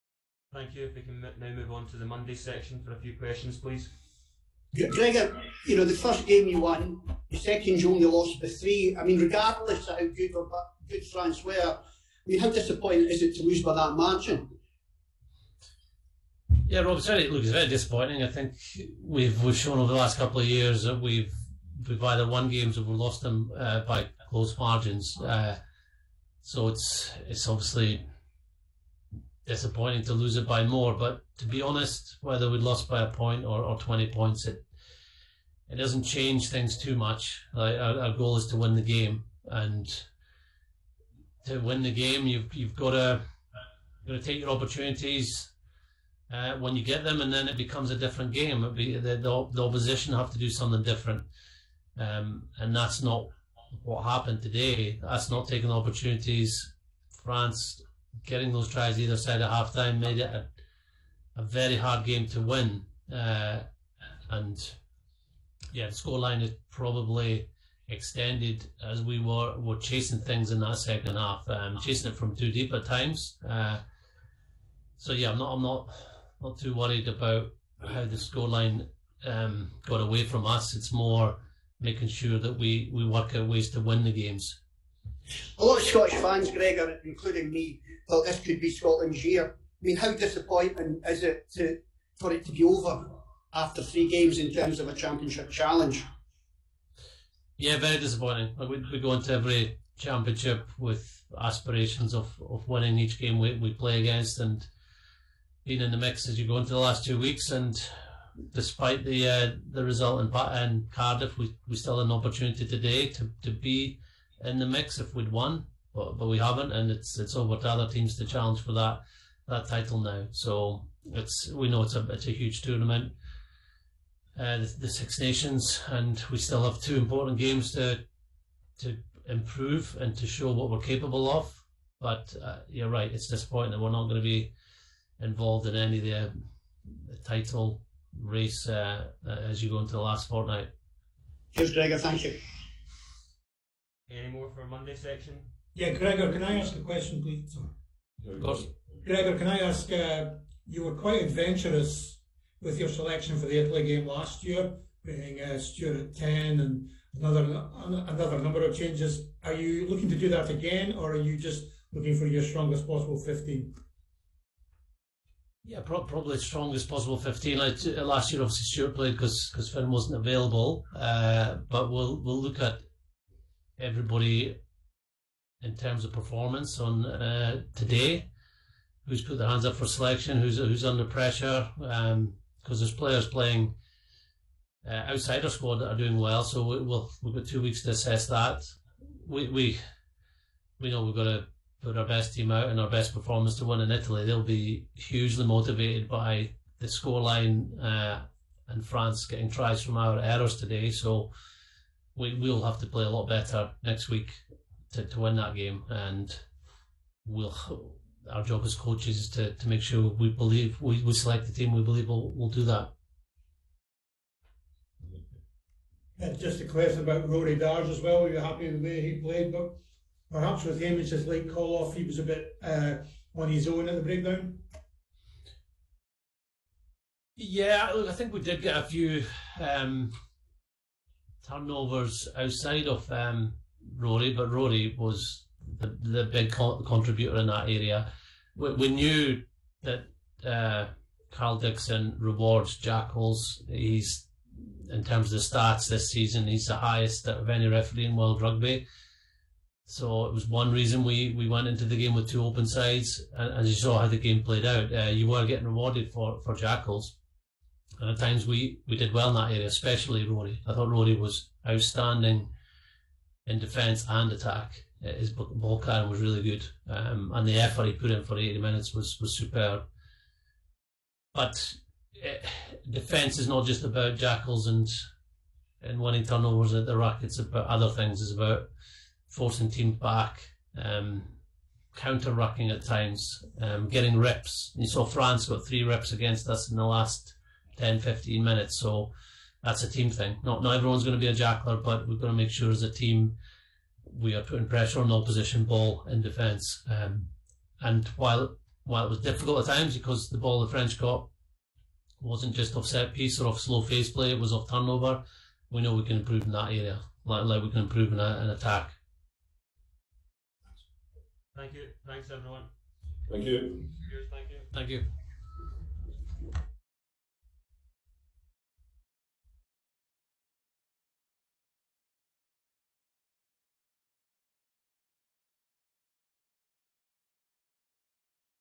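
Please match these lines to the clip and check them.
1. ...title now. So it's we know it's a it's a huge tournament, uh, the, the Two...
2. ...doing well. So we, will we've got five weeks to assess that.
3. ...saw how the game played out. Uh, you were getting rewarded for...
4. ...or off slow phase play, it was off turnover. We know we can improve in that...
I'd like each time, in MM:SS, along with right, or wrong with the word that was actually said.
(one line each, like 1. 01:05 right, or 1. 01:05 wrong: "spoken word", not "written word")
1. 01:59 wrong: "Six", not "Two"
2. 03:05 wrong: "two", not "five"
3. 04:13 right
4. 05:03 right.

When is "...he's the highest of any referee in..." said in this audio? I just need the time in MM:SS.
04:06.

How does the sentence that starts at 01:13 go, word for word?
Uh, so yeah, I'm not I'm not not too worried about how the scoreline um, got away from us.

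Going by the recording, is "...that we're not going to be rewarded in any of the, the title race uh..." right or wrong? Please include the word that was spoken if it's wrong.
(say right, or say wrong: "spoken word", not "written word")
wrong: "involved", not "rewarded".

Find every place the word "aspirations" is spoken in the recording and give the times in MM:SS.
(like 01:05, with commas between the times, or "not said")
01:41.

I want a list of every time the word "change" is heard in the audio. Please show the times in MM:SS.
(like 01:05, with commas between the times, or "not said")
00:36, 02:38.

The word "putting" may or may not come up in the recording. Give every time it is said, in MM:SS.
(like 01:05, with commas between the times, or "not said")
02:35, 04:54.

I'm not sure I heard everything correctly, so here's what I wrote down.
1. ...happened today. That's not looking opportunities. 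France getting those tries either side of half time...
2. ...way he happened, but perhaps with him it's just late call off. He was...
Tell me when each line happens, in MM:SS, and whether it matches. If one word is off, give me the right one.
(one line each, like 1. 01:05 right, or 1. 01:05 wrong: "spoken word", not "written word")
1. 00:54 wrong: "taking", not "looking"
2. 03:38 wrong: "played", not "happened".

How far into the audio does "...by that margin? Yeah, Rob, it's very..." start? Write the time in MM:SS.
00:13.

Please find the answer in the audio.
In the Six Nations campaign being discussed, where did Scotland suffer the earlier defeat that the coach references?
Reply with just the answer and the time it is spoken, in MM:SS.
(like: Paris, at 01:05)
Cardiff, at 01:50.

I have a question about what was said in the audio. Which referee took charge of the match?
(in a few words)
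Karl Dickson.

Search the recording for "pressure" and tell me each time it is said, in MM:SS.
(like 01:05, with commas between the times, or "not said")
03:01, 04:54.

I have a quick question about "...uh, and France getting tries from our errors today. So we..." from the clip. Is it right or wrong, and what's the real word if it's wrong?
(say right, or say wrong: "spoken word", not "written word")
right.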